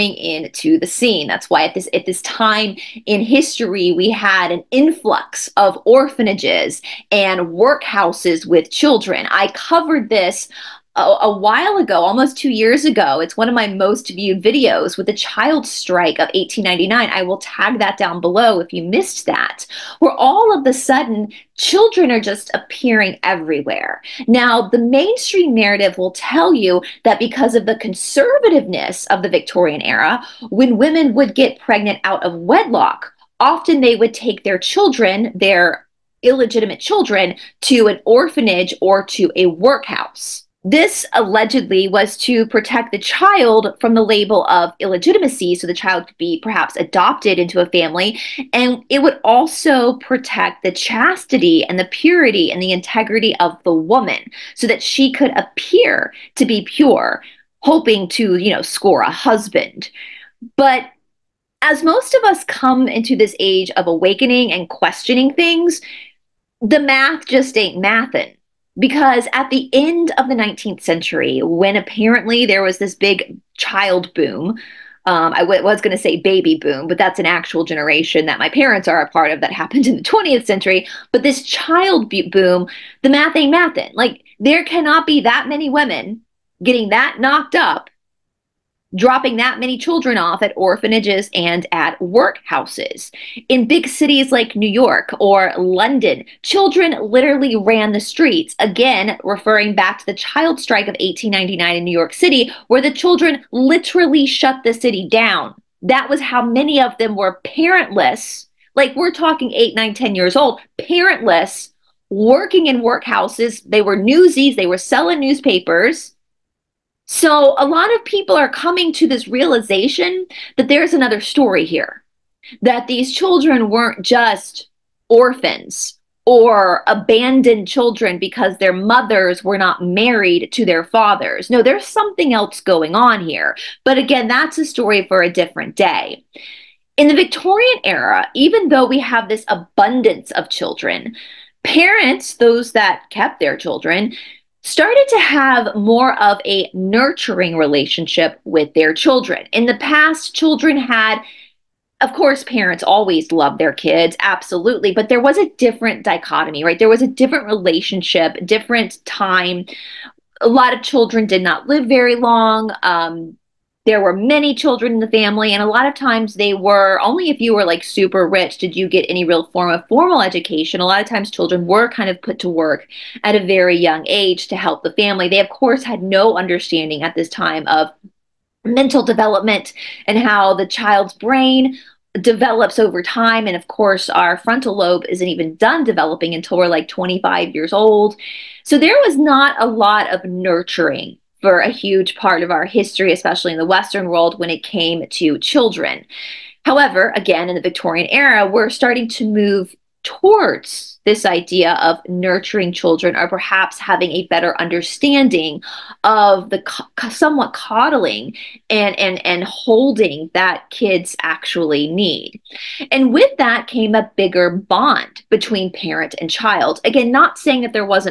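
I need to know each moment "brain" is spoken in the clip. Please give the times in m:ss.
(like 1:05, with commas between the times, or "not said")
3:01.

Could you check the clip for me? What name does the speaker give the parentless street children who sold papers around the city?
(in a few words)
Newsies.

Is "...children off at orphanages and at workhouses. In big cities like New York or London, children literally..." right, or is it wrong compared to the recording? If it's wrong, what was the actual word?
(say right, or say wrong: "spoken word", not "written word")
right.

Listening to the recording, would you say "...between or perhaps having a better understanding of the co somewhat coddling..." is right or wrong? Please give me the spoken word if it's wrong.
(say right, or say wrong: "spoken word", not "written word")
wrong: "children", not "between".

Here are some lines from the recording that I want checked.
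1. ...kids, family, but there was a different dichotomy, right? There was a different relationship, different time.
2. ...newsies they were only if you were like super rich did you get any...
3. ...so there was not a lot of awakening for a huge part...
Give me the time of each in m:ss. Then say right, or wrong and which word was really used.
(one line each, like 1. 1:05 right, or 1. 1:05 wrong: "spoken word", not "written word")
1. 2:33 wrong: "absolutely", not "family"
2. 2:45 wrong: "times", not "newsies"
3. 3:08 wrong: "nurturing", not "awakening".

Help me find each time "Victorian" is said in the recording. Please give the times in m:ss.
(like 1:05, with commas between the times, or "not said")
0:29, 2:17, 3:17.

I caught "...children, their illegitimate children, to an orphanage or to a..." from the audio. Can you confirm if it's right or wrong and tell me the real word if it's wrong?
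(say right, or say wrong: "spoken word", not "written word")
right.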